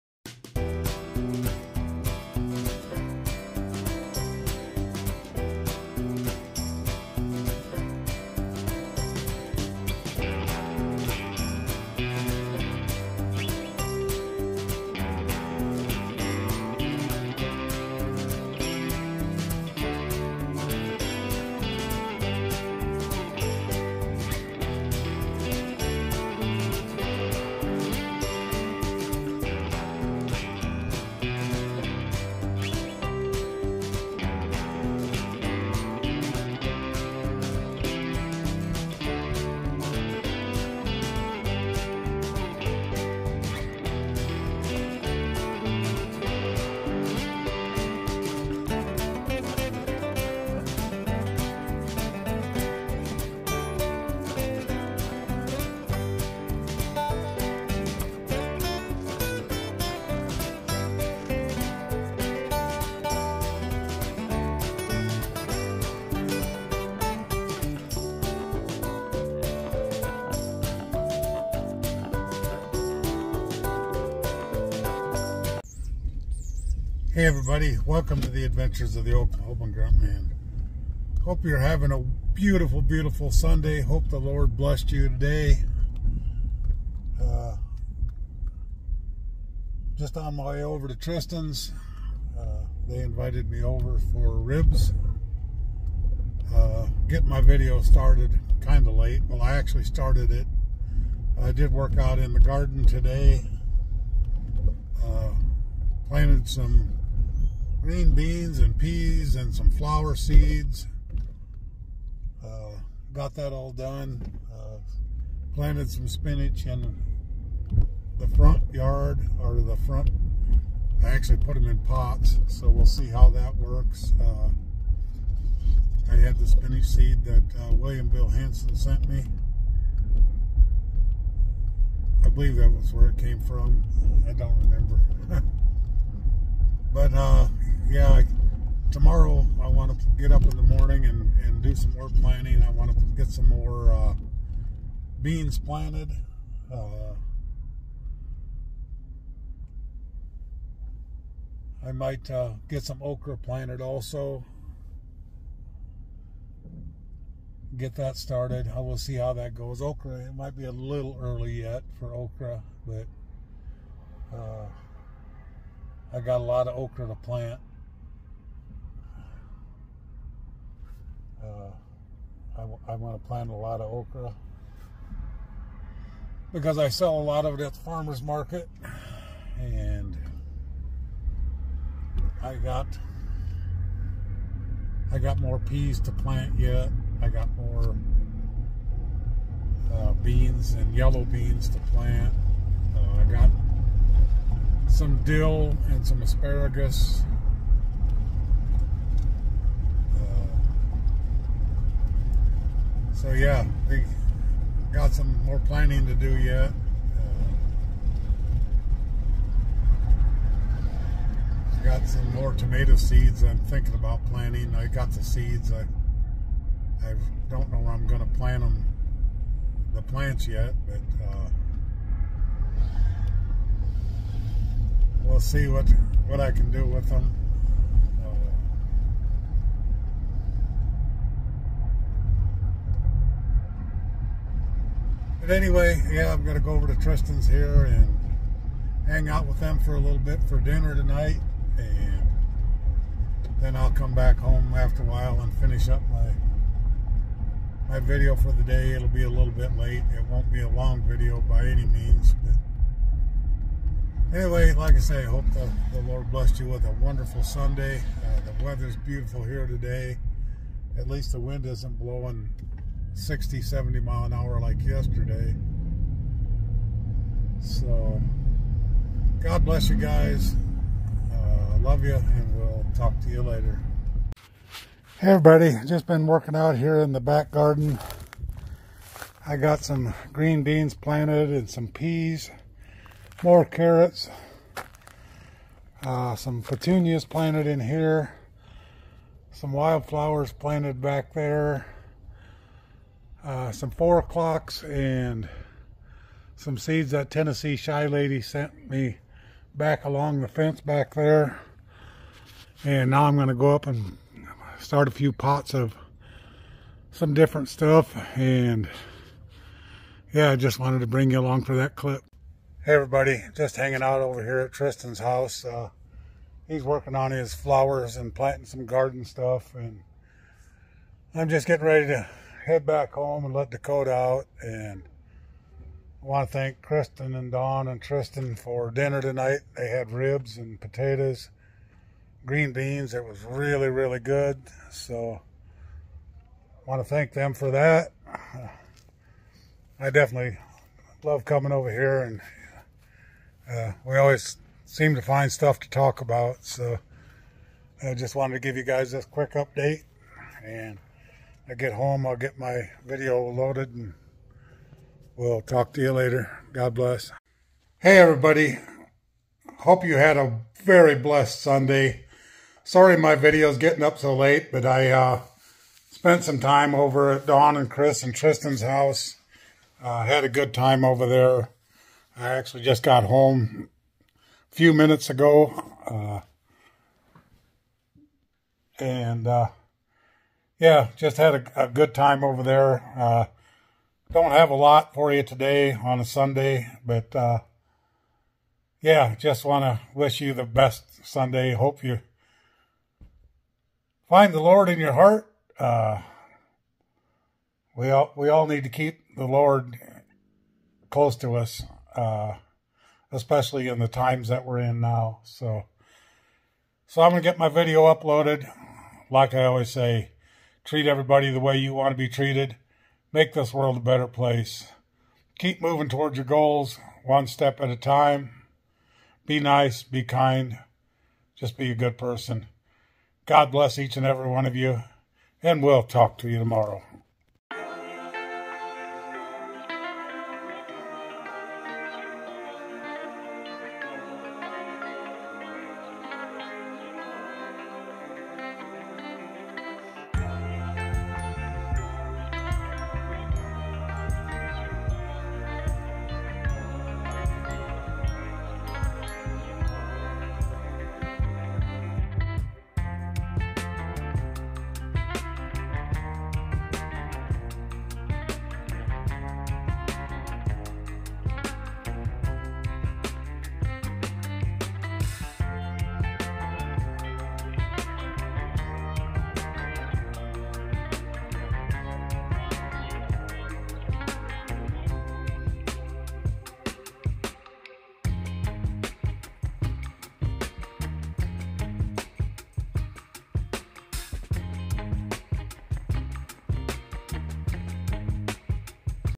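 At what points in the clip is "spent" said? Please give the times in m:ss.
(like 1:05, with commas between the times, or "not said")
6:06.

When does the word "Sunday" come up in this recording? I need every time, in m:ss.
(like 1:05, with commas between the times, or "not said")
1:23, 4:17, 6:01, 6:26, 6:31.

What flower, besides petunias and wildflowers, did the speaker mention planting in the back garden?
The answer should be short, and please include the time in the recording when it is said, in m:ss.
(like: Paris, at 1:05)
Four o'clocks, at 4:53.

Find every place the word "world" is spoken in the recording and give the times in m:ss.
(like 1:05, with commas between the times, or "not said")
6:53.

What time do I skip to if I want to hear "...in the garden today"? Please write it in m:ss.
1:42.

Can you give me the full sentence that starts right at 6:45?
So, so I'm gonna get my video uploaded.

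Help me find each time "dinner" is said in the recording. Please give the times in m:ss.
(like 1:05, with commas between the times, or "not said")
4:00, 5:28.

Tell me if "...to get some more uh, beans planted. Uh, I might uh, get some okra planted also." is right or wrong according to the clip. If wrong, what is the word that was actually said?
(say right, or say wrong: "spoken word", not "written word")
right.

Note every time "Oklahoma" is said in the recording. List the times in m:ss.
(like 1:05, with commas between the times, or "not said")
1:19.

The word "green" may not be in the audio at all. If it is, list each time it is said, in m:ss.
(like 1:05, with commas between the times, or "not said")
1:47, 4:40, 5:32.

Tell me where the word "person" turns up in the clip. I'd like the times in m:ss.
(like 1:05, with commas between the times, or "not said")
7:02.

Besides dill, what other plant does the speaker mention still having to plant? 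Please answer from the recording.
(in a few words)
Asparagus.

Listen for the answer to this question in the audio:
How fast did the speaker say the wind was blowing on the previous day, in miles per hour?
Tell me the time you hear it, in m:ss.
4:23.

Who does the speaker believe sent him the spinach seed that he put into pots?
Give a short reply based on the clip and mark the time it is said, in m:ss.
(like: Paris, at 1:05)
William Bill Hanson, at 2:07.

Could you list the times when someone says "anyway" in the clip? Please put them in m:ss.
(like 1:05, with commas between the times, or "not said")
3:55, 4:14.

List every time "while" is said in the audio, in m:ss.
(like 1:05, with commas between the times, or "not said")
4:05.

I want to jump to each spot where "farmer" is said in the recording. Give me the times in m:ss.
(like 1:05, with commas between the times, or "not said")
2:57.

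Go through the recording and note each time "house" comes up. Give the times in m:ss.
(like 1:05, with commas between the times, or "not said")
5:15, 6:08.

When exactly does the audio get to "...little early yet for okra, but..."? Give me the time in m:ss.
2:40.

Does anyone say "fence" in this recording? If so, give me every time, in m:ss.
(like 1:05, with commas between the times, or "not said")
5:00.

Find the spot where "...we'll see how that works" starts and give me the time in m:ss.
2:02.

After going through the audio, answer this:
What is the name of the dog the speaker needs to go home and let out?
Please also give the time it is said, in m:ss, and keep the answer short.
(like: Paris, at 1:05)
Dakota, at 5:23.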